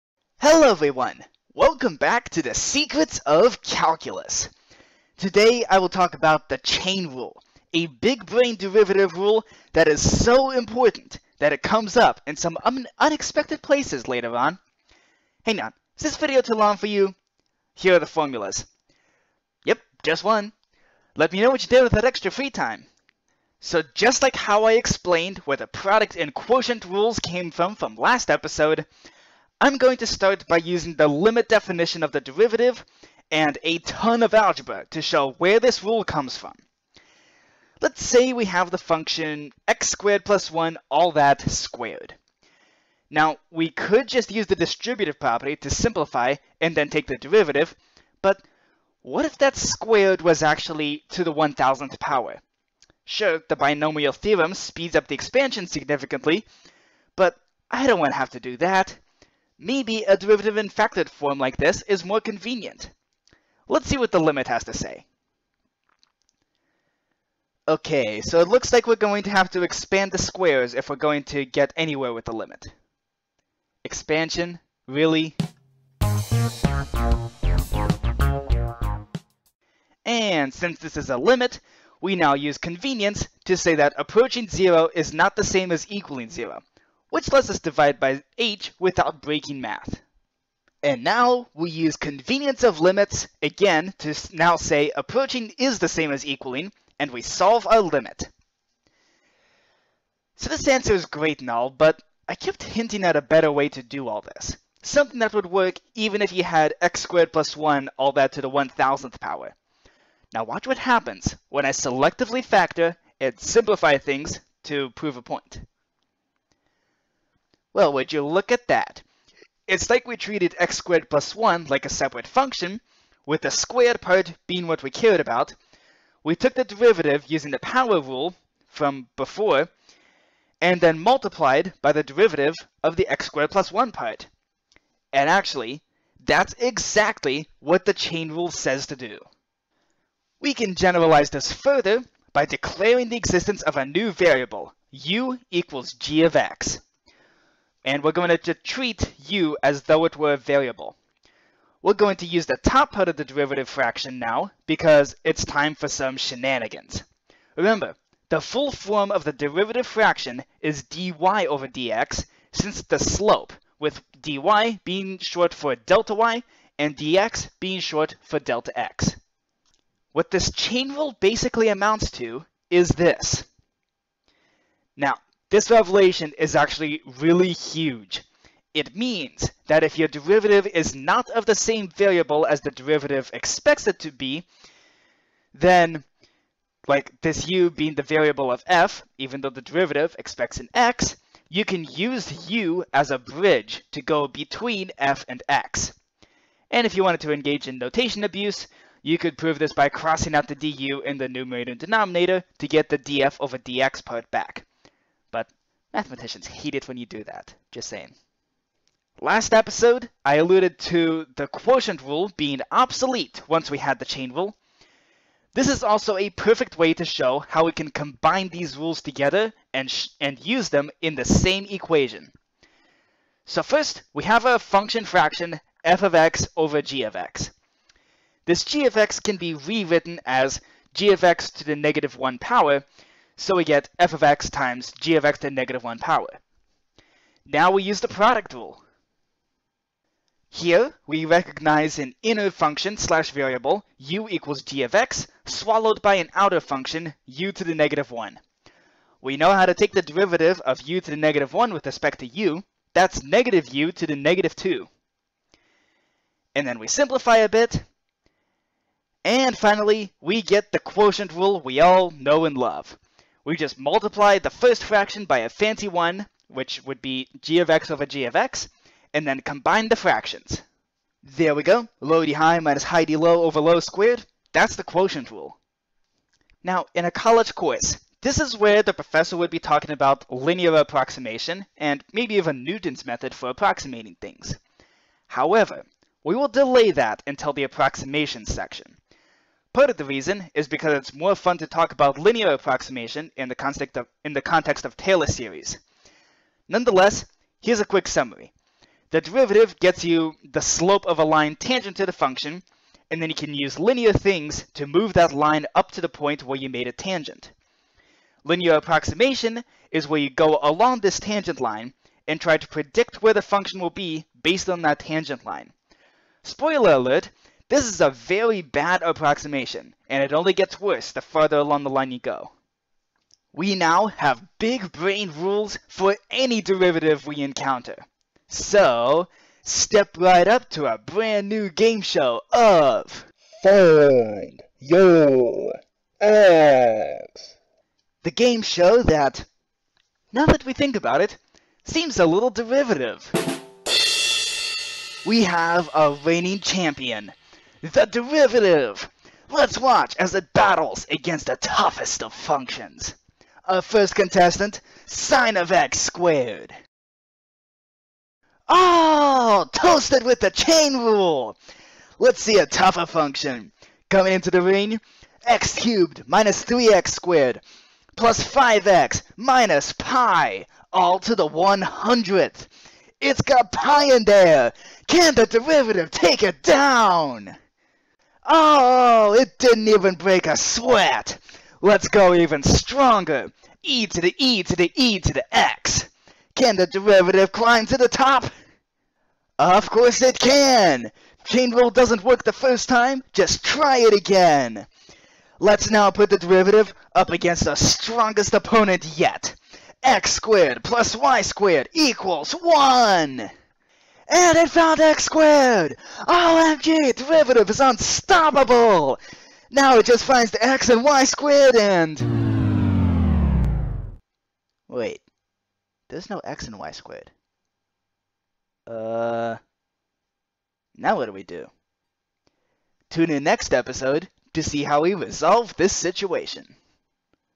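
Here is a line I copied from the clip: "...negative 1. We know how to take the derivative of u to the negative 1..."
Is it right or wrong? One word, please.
right.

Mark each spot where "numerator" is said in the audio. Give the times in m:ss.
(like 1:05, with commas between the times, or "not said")
3:21.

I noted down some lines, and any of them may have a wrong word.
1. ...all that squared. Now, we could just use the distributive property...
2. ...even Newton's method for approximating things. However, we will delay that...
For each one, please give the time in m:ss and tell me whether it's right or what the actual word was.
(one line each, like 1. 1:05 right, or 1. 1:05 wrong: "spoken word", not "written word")
1. 0:40 right
2. 4:42 right.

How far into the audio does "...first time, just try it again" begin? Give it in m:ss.
6:32.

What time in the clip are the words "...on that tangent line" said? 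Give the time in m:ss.
5:14.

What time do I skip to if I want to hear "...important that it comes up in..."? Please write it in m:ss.
0:10.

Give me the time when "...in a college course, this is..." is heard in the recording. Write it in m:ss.
4:36.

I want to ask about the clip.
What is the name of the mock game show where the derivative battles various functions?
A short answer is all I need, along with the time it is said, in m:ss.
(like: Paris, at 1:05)
Find Your X, at 5:33.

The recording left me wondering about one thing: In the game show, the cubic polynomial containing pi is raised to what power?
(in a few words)
100th.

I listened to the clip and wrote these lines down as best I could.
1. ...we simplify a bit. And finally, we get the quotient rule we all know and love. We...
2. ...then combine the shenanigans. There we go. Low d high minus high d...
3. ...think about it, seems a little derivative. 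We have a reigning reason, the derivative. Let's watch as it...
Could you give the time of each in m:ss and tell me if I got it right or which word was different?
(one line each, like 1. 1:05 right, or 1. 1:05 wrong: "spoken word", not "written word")
1. 4:16 right
2. 4:29 wrong: "fractions", not "shenanigans"
3. 5:40 wrong: "champion", not "reason".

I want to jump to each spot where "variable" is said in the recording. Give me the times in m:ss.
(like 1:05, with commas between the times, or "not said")
2:24, 2:30, 3:01, 3:08, 4:03.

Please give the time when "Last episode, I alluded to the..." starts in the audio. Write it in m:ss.
3:29.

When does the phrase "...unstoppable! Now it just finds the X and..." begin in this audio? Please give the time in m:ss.
6:47.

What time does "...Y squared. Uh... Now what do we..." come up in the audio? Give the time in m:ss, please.
6:56.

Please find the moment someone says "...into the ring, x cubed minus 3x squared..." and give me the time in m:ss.
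6:04.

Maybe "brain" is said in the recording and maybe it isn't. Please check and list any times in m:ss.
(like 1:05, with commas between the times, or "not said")
0:08, 5:24.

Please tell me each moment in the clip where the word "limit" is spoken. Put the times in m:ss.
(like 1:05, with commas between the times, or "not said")
0:31, 1:04, 1:12, 1:21, 1:32, 1:37.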